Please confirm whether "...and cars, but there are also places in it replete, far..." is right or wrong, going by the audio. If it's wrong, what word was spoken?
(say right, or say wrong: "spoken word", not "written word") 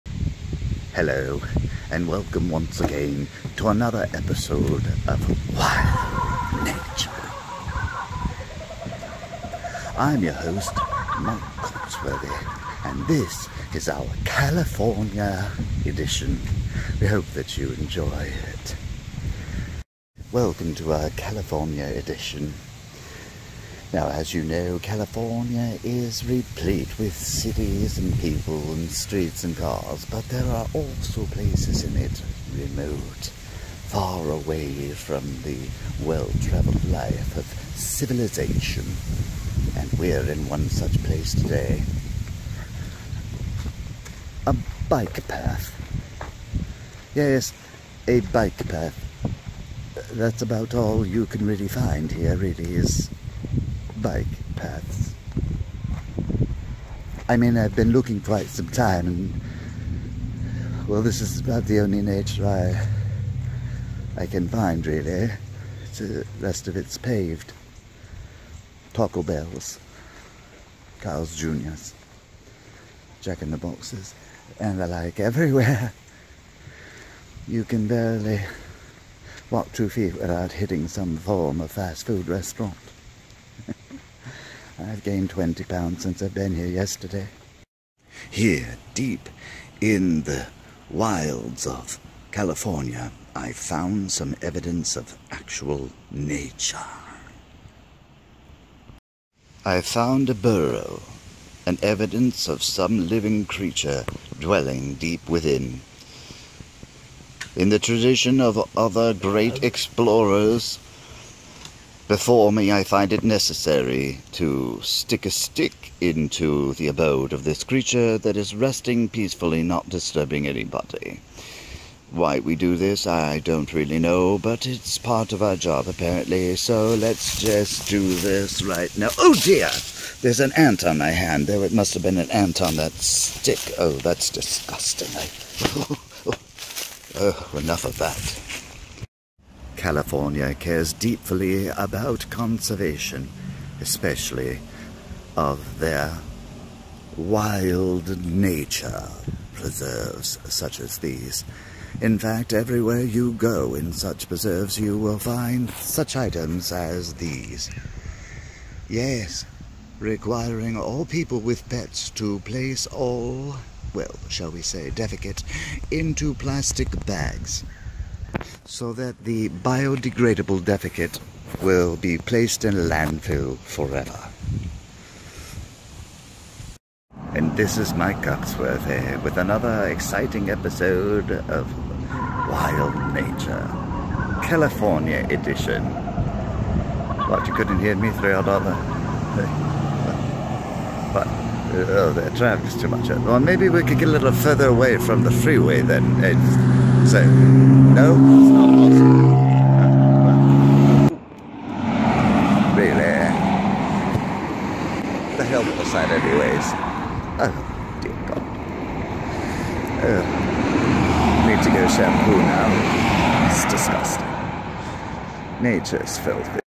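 wrong: "remote", not "replete".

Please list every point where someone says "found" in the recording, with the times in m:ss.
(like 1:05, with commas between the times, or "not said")
1:33, 1:39.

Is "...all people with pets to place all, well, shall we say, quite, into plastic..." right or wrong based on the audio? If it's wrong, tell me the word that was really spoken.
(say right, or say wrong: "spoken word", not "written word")
wrong: "defecate", not "quite".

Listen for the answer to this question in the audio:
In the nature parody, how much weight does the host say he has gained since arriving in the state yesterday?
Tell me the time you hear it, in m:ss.
1:25.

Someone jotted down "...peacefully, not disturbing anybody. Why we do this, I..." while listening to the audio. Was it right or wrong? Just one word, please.
right.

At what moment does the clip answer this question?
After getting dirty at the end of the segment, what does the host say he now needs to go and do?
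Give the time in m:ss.
3:31.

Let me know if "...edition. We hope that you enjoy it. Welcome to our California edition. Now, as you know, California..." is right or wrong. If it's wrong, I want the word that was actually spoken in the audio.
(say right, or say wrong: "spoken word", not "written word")
right.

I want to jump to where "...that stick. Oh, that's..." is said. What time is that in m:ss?
2:12.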